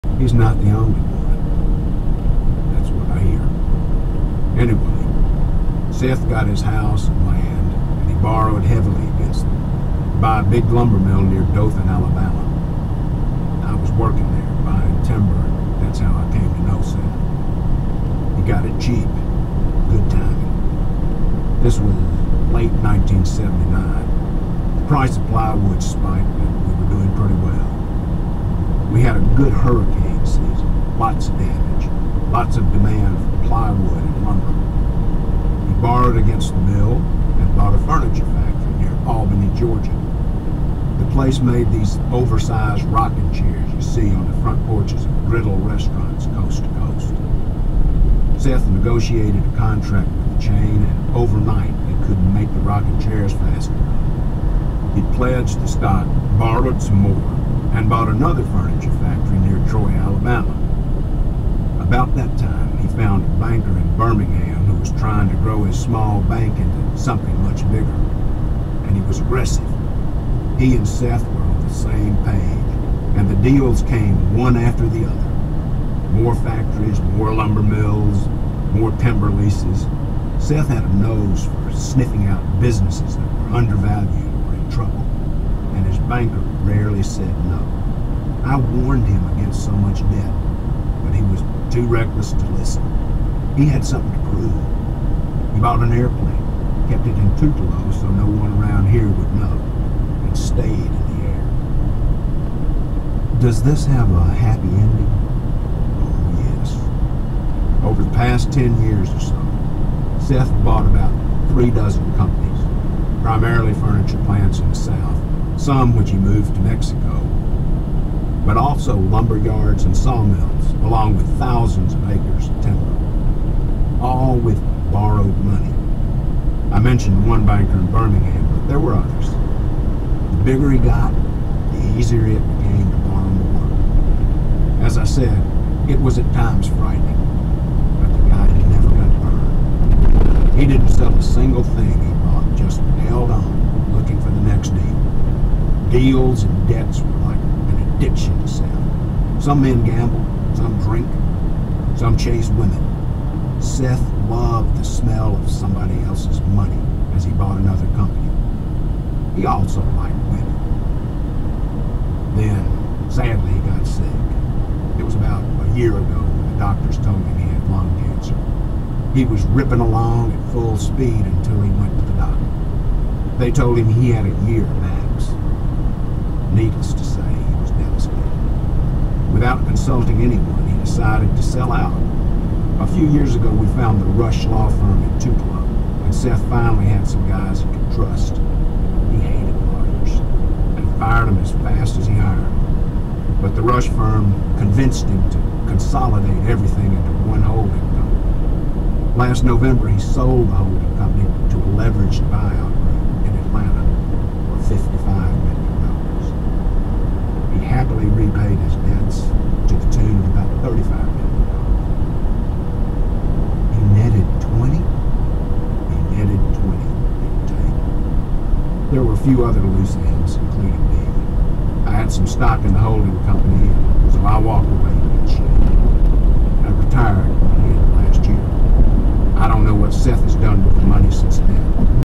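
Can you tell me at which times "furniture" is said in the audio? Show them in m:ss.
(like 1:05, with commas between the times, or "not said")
0:37, 0:58, 1:53.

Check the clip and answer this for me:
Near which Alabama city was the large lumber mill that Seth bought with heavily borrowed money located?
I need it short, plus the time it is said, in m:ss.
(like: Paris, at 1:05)
Dothan, at 0:11.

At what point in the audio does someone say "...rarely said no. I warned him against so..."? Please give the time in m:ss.
1:26.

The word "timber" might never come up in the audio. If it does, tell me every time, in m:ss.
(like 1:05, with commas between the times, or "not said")
0:15, 1:18, 2:02.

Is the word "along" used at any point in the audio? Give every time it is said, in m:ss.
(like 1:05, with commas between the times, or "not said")
2:00, 2:49.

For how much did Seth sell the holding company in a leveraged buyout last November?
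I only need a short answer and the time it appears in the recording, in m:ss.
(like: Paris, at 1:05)
35 million, at 3:30.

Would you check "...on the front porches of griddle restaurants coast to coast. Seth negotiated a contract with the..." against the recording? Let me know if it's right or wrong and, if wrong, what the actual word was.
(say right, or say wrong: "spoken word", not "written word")
right.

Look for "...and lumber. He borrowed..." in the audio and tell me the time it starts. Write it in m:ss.
0:34.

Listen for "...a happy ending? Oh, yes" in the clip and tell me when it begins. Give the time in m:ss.
1:44.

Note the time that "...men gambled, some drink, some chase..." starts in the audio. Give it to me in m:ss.
2:29.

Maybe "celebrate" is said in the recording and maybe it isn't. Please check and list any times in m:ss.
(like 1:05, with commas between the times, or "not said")
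not said.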